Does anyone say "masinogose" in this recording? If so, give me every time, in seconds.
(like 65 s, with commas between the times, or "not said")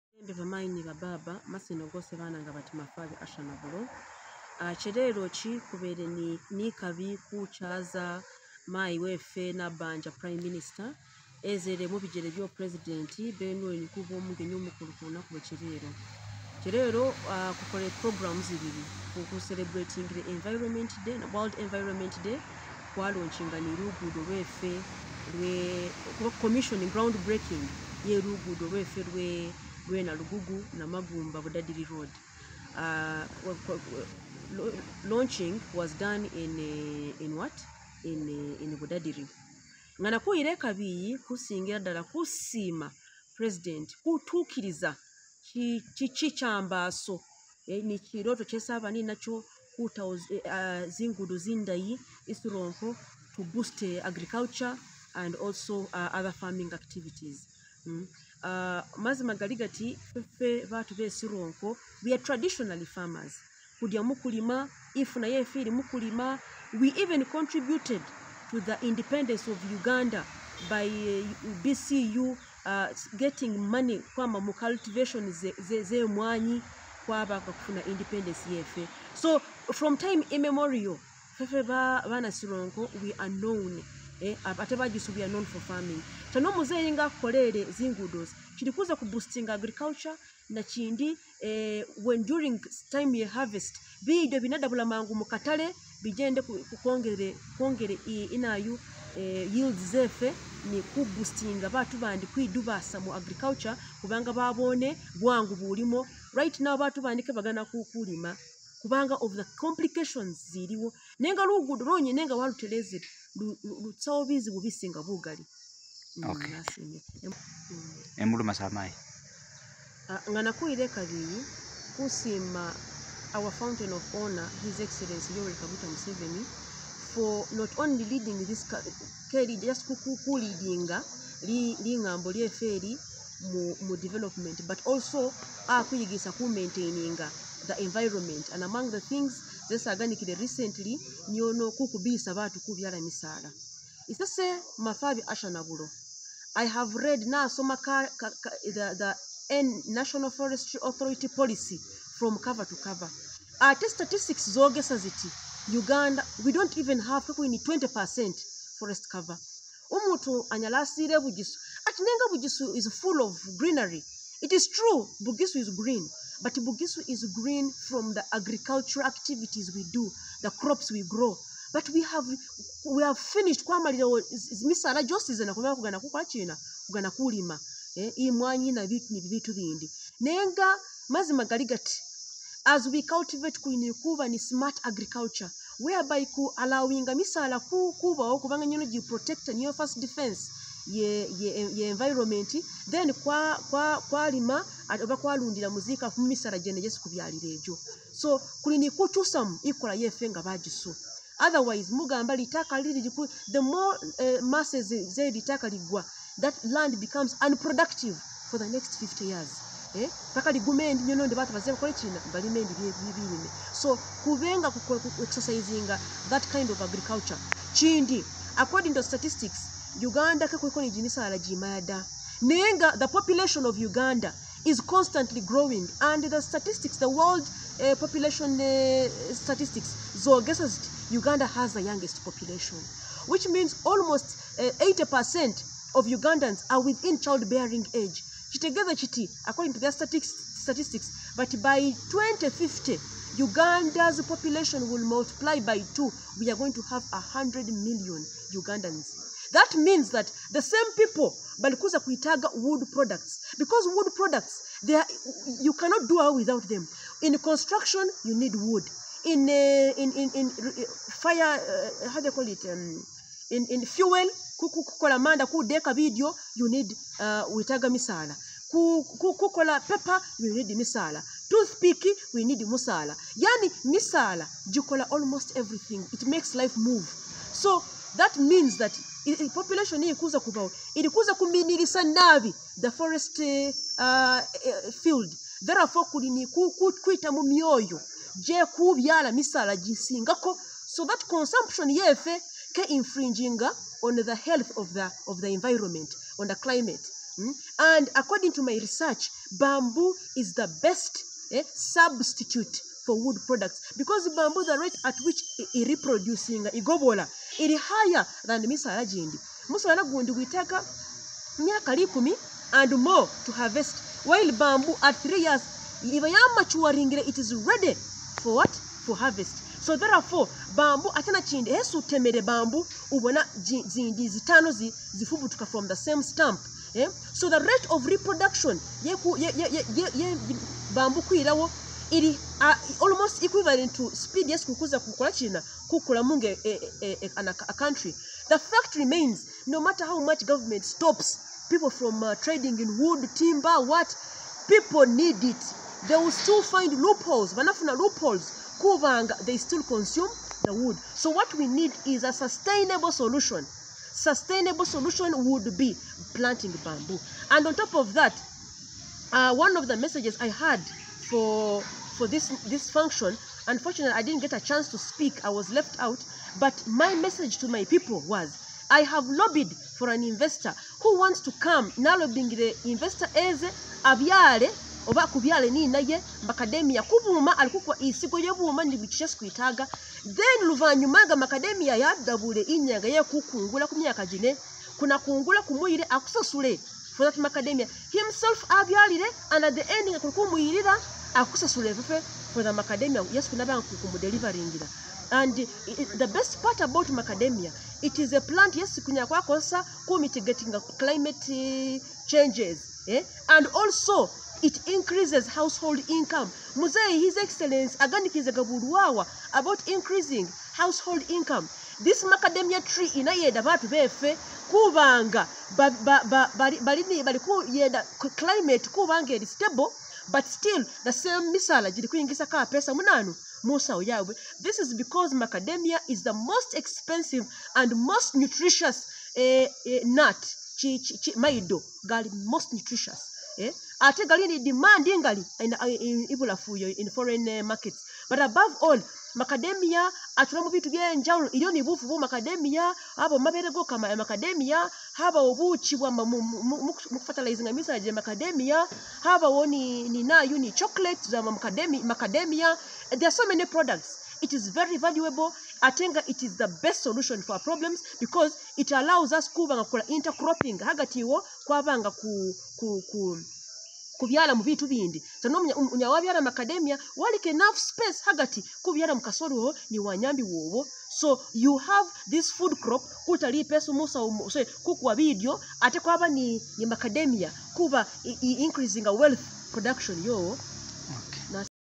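1 s.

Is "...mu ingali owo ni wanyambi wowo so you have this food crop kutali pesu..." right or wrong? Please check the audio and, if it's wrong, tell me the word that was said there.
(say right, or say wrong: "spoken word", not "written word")
wrong: "kasoli", not "ingali".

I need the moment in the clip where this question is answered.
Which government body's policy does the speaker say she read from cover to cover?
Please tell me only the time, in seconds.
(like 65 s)
149 s.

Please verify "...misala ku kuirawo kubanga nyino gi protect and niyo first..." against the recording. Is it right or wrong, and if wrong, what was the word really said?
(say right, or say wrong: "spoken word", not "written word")
wrong: "kubawo", not "kuirawo".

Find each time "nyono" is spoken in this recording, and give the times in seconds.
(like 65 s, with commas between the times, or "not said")
141 s, 211 s.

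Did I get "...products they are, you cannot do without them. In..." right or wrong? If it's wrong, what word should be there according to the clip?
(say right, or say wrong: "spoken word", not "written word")
right.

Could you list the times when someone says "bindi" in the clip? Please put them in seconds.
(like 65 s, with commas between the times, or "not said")
179 s, 464 s.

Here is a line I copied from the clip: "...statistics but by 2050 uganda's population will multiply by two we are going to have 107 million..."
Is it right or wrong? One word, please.
wrong.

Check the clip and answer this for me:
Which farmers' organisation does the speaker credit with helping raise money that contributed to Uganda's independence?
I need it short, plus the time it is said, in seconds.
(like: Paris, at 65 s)
BCU, at 71 s.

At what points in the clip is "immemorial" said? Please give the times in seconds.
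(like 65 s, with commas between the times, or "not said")
80 s.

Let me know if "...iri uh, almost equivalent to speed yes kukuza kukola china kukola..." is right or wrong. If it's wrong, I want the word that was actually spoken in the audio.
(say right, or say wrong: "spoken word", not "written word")
right.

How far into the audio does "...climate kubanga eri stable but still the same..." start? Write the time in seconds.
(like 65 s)
418 s.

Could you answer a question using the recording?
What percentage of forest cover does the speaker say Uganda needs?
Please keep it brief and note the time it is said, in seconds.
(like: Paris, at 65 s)
20 percent, at 157 s.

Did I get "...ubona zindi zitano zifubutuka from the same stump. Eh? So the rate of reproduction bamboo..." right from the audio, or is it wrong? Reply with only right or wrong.
right.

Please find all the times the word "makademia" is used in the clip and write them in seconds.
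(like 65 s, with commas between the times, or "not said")
376 s, 381 s, 387 s.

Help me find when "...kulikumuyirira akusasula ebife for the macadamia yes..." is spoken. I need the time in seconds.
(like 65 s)
390 s.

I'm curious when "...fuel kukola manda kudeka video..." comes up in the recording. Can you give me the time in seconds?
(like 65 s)
263 s.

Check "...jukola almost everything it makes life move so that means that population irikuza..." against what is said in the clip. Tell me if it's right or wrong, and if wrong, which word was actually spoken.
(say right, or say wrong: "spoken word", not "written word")
right.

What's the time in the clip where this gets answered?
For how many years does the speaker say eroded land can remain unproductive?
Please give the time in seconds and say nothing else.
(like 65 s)
208 s.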